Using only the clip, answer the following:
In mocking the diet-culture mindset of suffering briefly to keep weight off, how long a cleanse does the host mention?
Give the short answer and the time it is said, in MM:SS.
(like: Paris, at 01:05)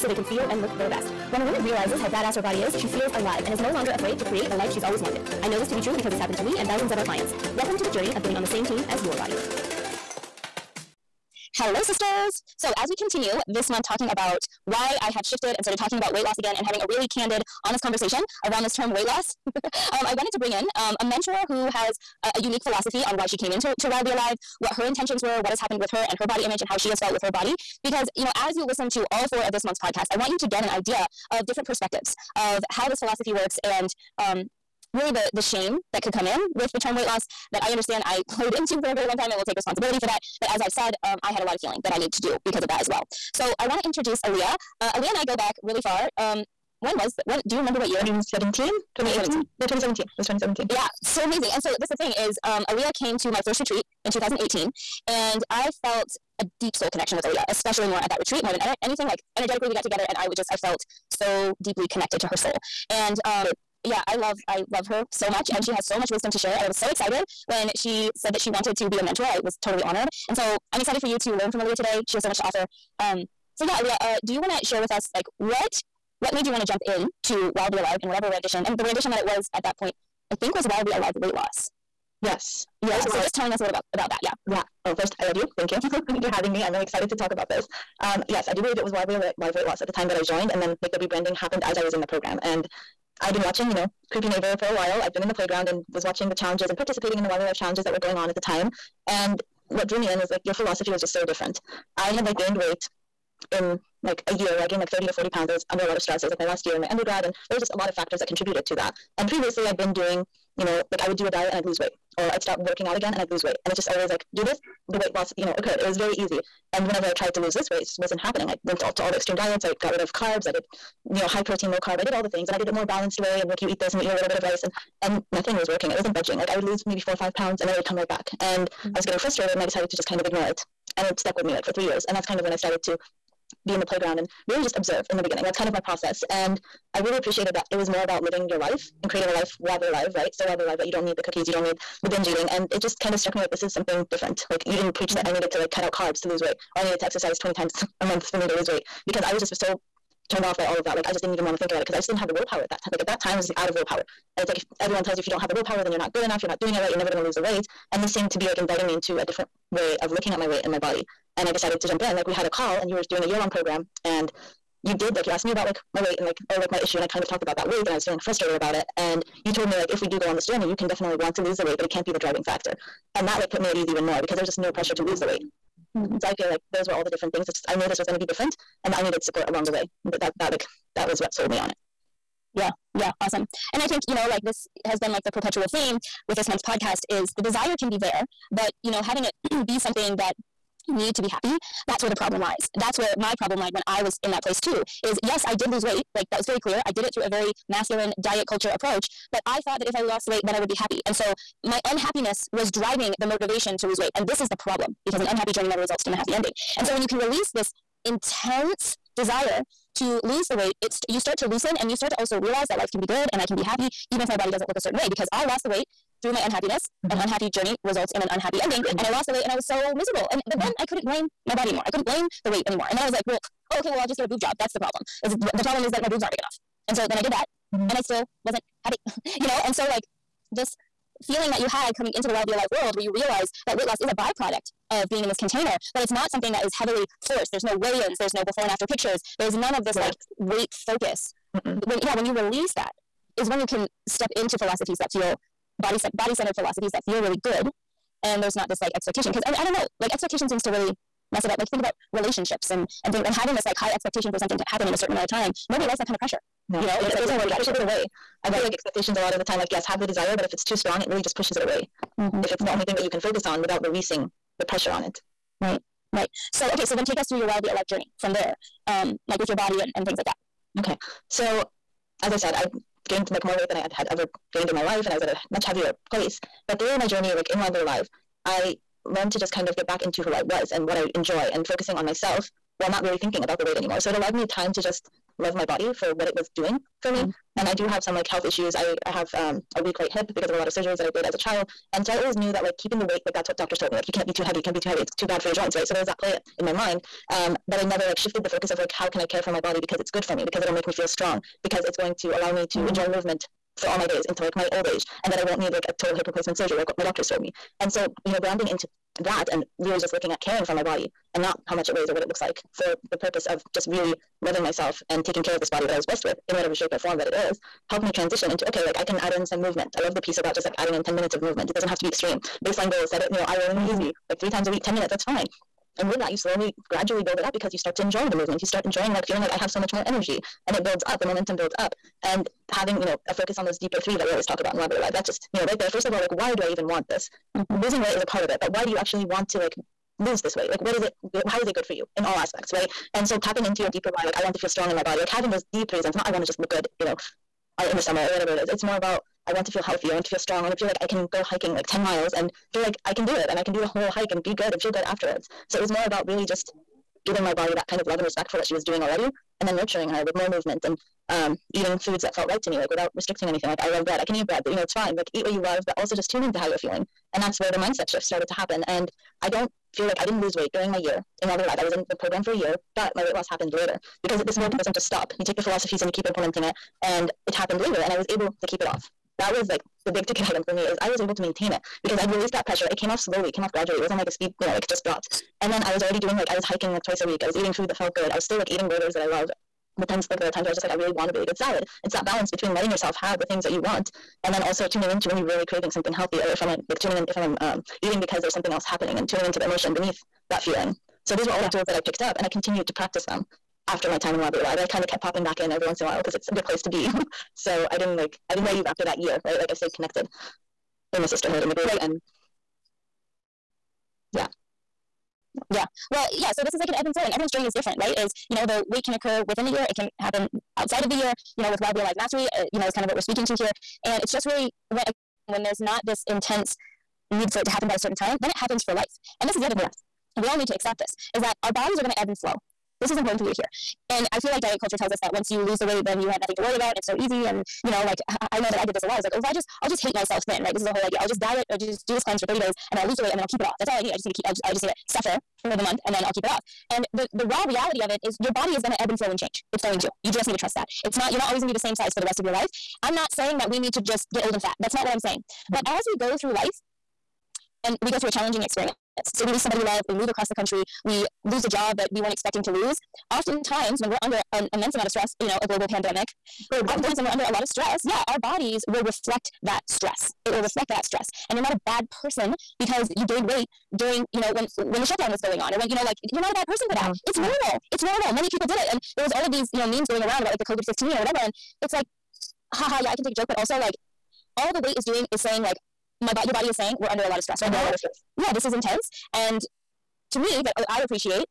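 30 days, at 07:22.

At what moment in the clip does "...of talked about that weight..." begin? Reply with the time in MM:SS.
02:47.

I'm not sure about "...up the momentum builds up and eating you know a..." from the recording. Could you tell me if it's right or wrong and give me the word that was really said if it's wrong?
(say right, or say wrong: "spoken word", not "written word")
wrong: "having", not "eating".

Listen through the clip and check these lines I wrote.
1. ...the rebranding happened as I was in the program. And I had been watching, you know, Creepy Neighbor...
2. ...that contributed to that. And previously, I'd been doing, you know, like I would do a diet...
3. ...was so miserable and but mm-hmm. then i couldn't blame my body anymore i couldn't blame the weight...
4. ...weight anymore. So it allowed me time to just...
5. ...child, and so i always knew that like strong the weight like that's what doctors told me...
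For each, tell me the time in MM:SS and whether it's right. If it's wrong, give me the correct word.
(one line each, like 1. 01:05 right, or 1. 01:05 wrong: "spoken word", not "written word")
1. 01:30 right
2. 01:48 right
3. 03:39 right
4. 04:43 right
5. 04:51 wrong: "keeping", not "strong".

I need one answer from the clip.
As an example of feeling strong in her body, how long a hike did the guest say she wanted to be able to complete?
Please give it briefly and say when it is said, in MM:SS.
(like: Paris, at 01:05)
10 miles, at 05:51.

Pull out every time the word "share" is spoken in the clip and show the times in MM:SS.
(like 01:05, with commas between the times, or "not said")
01:06, 01:14.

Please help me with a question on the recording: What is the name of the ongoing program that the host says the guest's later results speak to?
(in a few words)
Wildly Alive Mastery.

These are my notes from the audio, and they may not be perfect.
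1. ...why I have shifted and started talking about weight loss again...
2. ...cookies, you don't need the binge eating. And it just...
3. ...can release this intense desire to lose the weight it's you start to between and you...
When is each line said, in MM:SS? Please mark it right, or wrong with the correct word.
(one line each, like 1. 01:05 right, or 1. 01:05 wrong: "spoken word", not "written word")
1. 00:14 right
2. 02:21 right
3. 03:27 wrong: "loosen", not "between".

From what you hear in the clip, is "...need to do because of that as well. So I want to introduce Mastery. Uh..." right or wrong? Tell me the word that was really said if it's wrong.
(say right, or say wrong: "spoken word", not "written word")
wrong: "Alia", not "Mastery".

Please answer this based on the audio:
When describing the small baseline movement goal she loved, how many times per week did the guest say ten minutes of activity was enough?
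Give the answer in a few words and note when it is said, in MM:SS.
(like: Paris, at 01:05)
3 times a week, at 05:24.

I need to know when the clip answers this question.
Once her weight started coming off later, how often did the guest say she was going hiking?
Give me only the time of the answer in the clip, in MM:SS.
06:27.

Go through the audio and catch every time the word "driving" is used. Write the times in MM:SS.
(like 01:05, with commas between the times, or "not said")
02:52, 03:22.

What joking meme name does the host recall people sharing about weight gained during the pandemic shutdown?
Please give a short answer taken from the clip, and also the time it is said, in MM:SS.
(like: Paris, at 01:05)
COVID 15, at 08:00.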